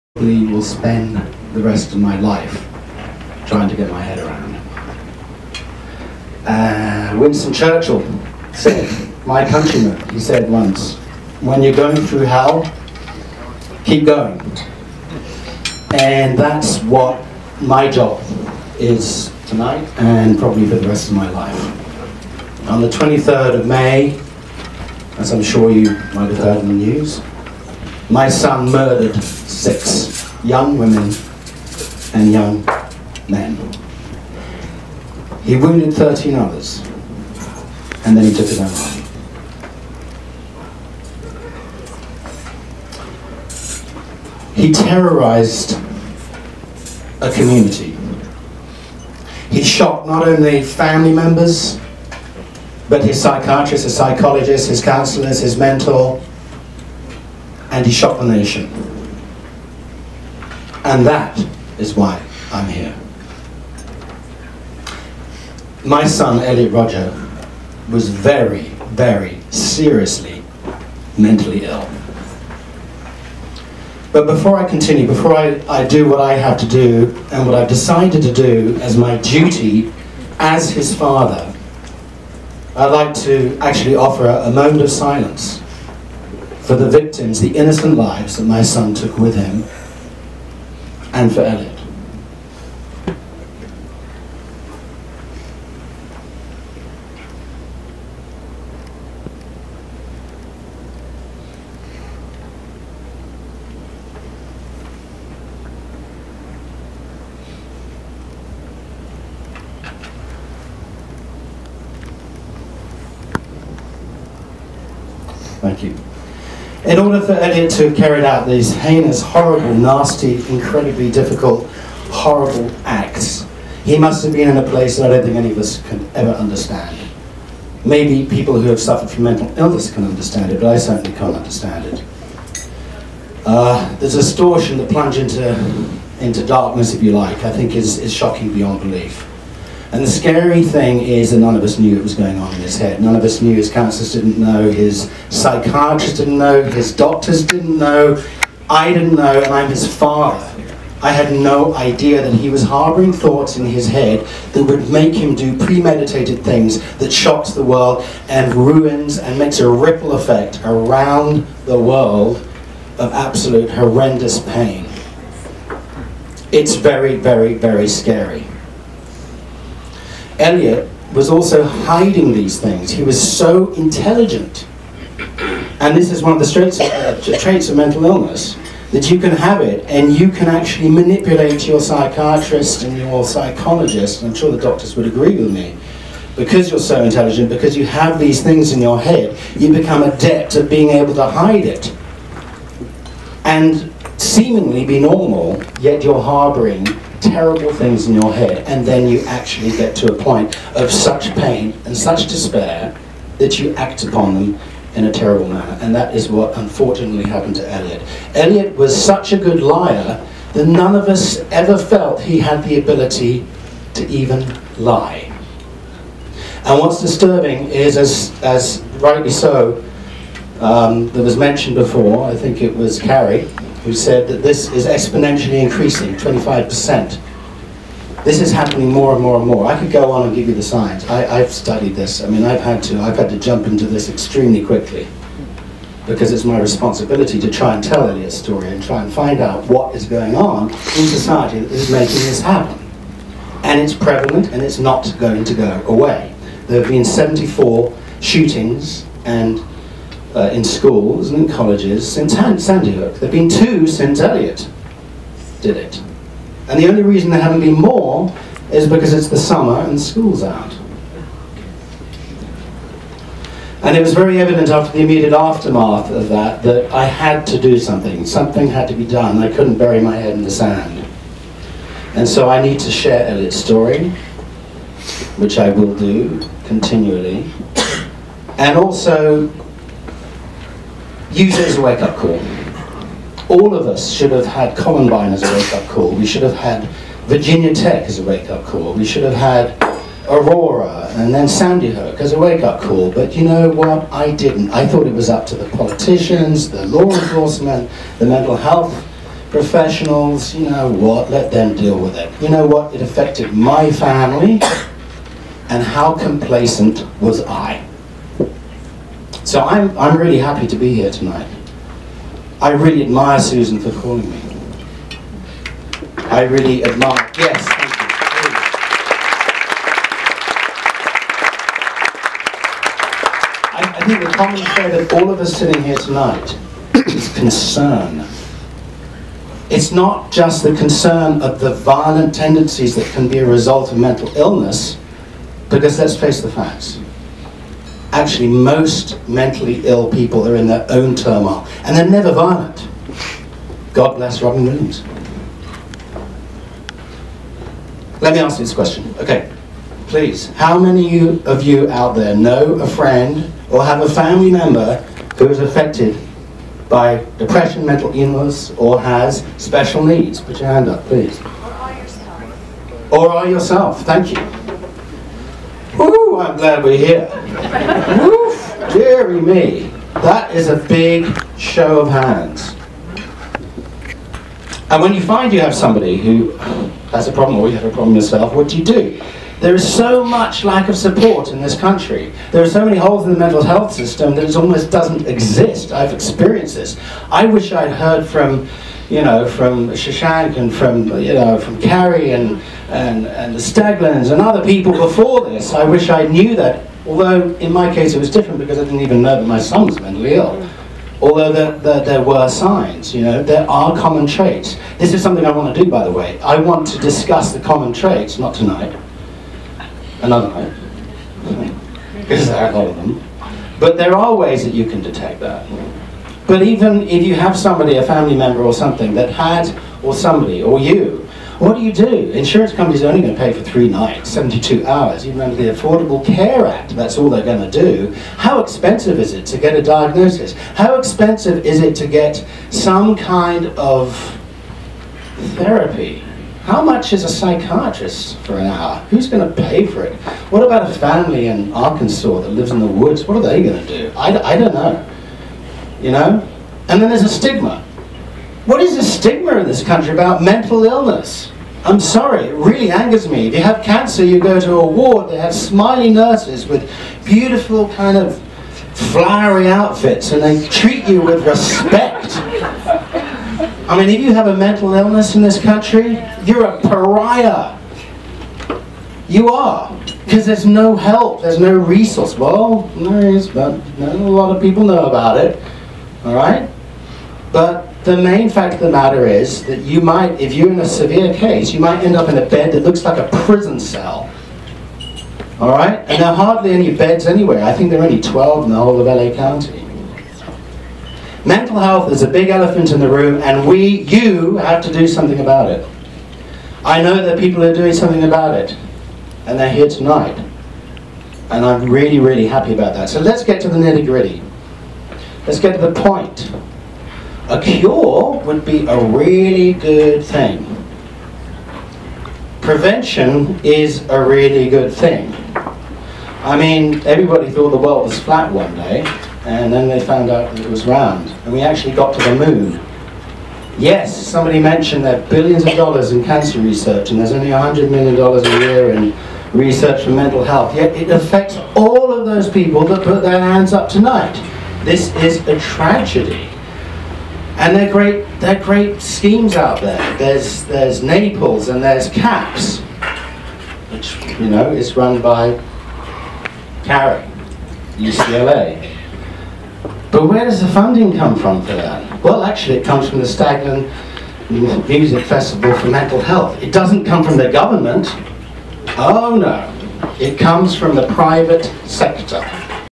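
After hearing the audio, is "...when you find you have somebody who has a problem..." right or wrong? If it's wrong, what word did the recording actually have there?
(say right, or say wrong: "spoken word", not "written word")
right.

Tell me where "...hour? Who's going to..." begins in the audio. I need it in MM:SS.
07:18.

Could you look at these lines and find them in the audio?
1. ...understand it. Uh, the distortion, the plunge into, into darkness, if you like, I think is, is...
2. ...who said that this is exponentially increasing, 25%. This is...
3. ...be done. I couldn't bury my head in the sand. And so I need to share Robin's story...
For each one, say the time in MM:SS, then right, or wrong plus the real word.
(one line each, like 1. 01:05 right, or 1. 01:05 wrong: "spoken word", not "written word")
1. 02:11 right
2. 03:43 right
3. 04:28 wrong: "Elliot", not "Robin".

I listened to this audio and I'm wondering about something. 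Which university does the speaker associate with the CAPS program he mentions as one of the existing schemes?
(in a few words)
UCLA.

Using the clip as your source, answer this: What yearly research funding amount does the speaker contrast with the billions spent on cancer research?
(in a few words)
$100 million.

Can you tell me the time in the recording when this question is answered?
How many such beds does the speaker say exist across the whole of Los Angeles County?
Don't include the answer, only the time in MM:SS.
08:08.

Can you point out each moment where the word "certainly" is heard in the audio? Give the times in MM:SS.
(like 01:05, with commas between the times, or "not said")
02:10.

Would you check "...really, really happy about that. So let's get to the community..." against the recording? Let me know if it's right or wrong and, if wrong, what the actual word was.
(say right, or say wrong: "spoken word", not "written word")
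wrong: "nitty", not "community".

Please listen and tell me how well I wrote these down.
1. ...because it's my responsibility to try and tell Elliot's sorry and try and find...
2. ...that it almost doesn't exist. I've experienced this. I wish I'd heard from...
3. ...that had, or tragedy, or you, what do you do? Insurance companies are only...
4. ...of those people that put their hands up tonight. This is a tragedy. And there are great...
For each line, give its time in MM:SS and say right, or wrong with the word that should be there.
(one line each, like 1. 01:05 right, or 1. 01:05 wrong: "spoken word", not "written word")
1. 03:56 wrong: "story", not "sorry"
2. 06:24 right
3. 06:59 wrong: "somebody", not "tragedy"
4. 08:52 right.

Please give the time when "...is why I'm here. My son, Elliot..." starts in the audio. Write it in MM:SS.
01:01.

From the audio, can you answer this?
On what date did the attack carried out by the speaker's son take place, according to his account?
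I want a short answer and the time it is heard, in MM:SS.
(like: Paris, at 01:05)
23rd of May, at 00:22.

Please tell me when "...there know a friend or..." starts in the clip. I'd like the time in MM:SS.
05:52.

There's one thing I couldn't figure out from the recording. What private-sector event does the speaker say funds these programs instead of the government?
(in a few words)
Staglin Music Festival.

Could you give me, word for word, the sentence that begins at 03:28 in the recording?
Elliot was such a good liar that none of us ever felt he had the ability to even lie.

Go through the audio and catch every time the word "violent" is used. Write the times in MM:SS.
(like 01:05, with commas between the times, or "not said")
05:31, 05:42.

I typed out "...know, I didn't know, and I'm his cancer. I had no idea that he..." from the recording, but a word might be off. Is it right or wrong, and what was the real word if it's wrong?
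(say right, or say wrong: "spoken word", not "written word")
wrong: "father", not "cancer".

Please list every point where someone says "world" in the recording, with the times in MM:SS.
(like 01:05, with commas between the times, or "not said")
02:37, 02:41, 08:37.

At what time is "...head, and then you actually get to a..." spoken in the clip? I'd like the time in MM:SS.
03:18.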